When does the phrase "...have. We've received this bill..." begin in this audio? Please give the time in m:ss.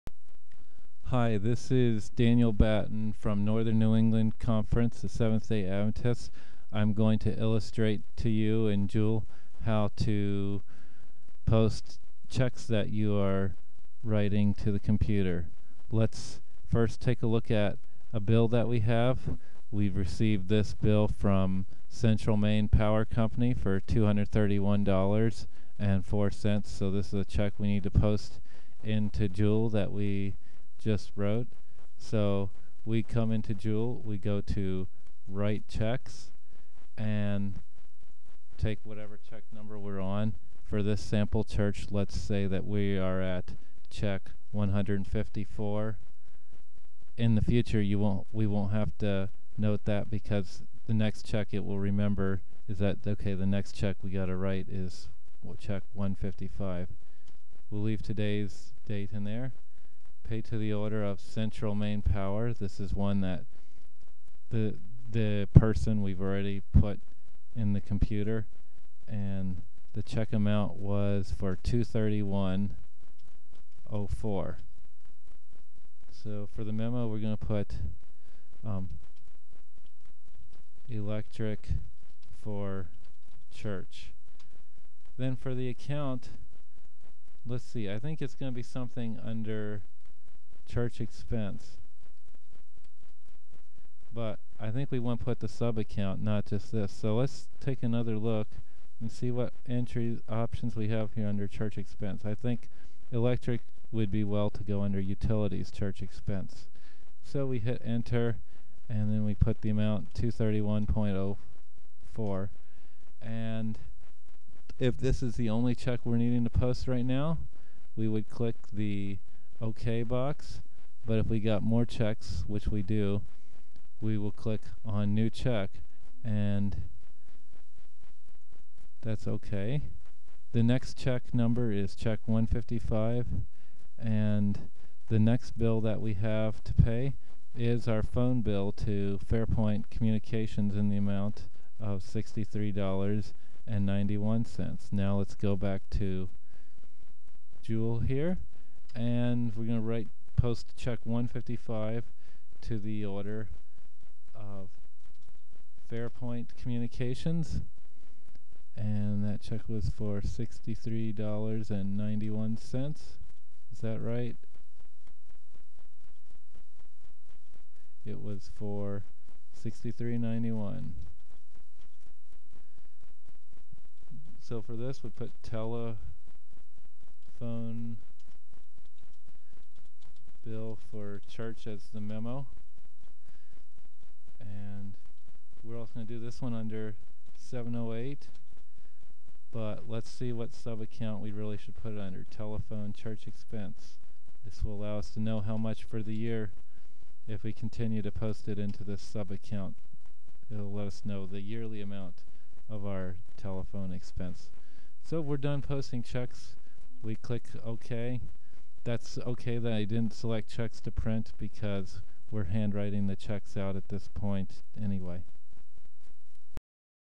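0:18.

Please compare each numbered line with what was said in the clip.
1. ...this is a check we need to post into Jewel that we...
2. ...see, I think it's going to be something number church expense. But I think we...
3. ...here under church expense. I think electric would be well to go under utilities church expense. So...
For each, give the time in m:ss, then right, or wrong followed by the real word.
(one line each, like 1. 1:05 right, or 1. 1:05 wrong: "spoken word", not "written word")
1. 0:26 right
2. 1:27 wrong: "under", not "number"
3. 1:41 right.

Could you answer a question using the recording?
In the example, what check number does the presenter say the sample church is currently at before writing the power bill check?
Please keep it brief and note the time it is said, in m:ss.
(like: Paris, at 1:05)
154, at 0:44.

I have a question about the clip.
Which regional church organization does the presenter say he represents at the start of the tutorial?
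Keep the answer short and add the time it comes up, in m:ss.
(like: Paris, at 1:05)
Northern New England Conference, at 0:03.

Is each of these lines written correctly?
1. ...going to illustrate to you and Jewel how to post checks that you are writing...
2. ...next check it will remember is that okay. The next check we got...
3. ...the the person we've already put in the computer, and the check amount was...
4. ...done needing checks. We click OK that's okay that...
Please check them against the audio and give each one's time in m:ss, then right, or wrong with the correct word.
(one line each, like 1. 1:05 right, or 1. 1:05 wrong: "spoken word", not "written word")
1. 0:06 right
2. 0:50 right
3. 1:04 right
4. 3:25 wrong: "posting", not "needing".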